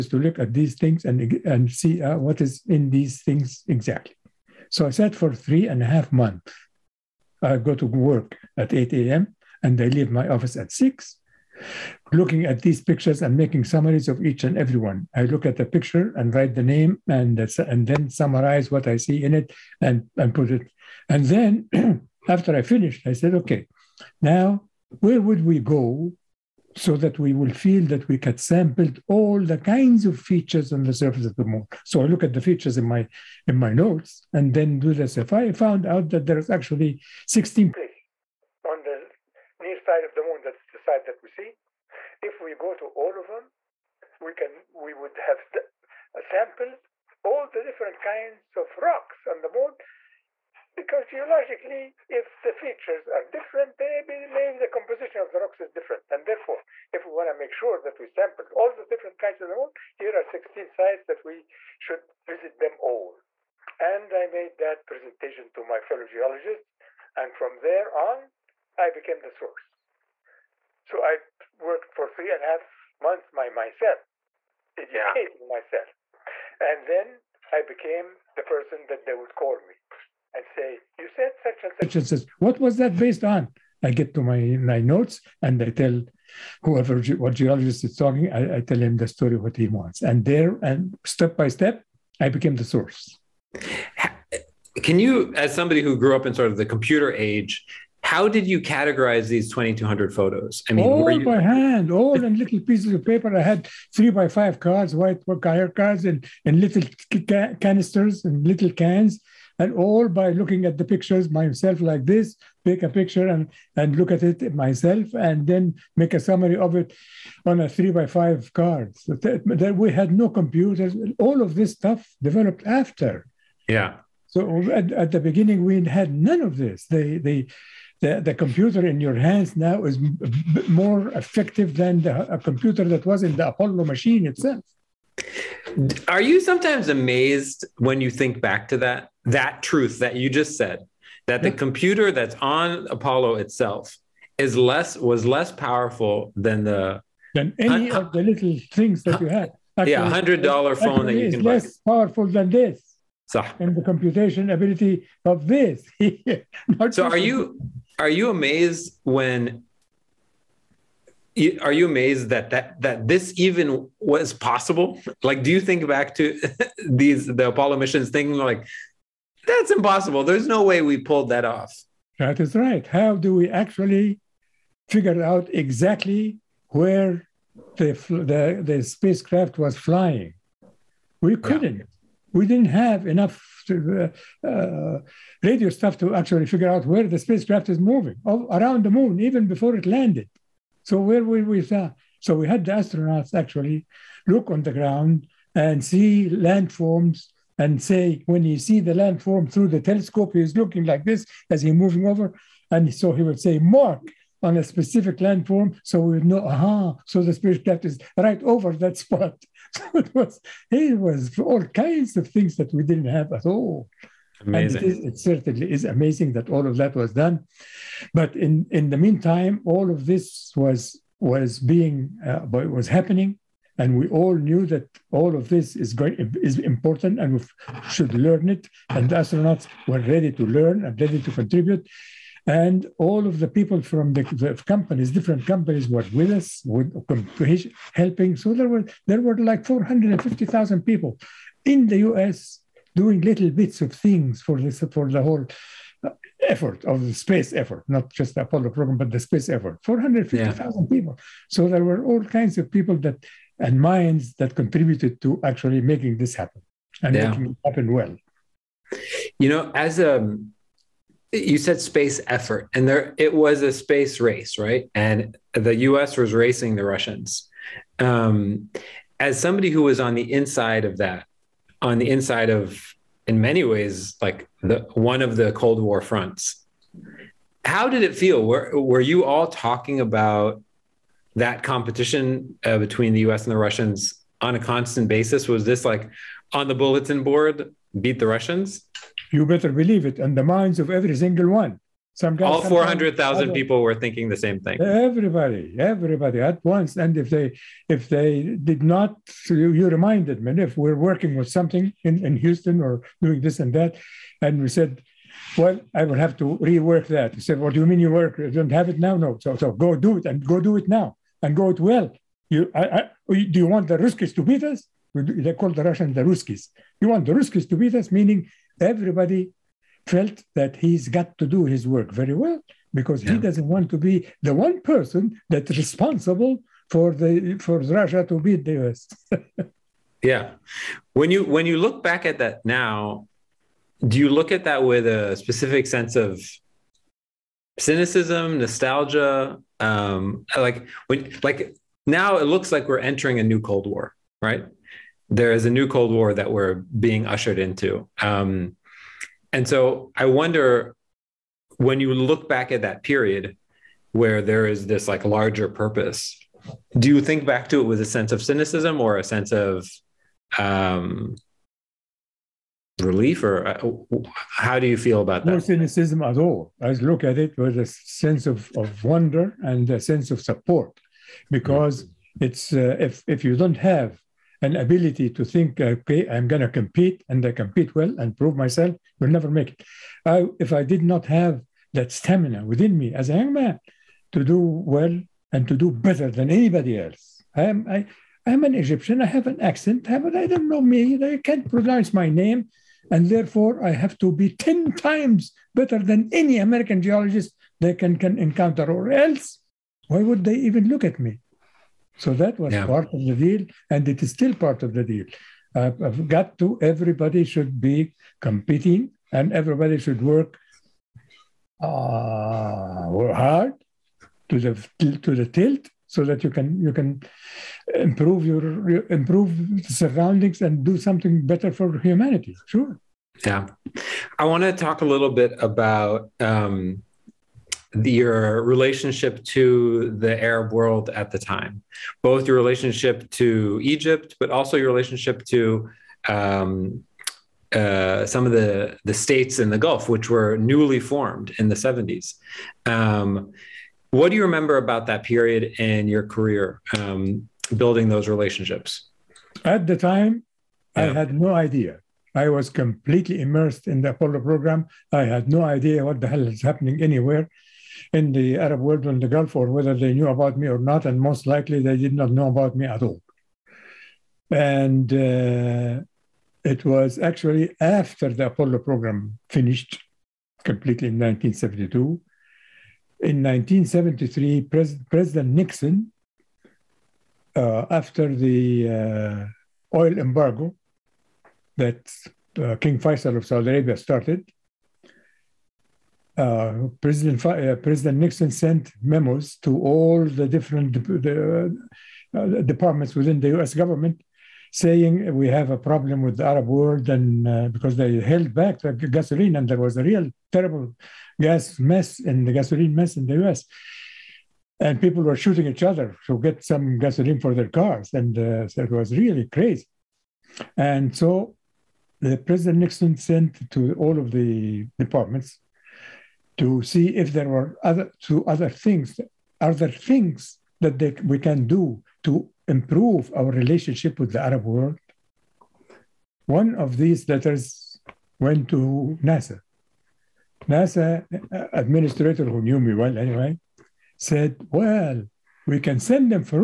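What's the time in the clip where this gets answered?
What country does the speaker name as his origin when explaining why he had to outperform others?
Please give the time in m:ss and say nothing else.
6:28.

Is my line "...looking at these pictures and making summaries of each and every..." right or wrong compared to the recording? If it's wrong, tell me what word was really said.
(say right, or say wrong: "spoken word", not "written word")
right.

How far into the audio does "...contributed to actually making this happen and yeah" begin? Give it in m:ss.
4:14.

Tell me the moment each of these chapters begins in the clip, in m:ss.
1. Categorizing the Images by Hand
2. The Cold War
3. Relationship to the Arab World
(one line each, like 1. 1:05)
1. 1:36
2. 4:39
3. 7:08.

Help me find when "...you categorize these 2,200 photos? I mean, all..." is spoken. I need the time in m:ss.
1:38.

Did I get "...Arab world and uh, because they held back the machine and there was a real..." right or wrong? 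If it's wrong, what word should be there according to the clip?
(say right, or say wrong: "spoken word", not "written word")
wrong: "gasoline", not "machine".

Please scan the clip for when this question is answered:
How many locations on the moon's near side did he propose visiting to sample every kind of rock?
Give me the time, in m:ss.
0:37.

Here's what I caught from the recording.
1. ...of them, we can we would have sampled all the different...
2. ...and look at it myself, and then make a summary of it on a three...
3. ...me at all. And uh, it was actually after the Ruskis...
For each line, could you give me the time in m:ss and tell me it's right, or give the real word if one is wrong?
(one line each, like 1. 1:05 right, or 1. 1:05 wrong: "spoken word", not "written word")
1. 0:43 right
2. 1:53 right
3. 7:42 wrong: "Apollo", not "Ruskis".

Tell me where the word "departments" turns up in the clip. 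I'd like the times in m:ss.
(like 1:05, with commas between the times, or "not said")
8:12, 8:34.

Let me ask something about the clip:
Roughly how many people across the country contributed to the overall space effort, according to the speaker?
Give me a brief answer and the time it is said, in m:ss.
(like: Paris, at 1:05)
450,000, at 3:59.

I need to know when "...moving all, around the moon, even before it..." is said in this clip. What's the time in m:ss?
3:07.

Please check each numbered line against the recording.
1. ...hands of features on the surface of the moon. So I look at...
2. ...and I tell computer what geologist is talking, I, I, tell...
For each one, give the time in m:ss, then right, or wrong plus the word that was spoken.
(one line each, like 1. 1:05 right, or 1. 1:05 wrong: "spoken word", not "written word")
1. 0:29 wrong: "kinds", not "hands"
2. 1:25 wrong: "whoever", not "computer".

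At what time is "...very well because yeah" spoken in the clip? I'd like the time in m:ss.
5:22.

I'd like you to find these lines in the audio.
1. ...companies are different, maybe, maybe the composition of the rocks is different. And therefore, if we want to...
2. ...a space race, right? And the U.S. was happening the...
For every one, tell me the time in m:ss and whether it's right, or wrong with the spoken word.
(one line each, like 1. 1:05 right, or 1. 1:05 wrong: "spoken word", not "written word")
1. 0:52 wrong: "features", not "companies"
2. 4:23 wrong: "racing", not "happening".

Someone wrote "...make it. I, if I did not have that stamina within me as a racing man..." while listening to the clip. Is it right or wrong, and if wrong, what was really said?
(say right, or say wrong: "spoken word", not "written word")
wrong: "young", not "racing".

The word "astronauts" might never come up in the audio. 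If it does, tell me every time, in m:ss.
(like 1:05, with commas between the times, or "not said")
3:12, 3:49.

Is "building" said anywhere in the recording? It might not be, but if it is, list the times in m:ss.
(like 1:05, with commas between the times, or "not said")
7:27.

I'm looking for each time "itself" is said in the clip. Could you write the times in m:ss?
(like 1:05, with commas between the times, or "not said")
2:14, 2:23.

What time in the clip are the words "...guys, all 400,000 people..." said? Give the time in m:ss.
4:52.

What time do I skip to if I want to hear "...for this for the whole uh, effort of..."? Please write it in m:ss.
4:04.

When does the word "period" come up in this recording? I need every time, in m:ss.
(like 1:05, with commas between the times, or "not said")
5:53, 7:25.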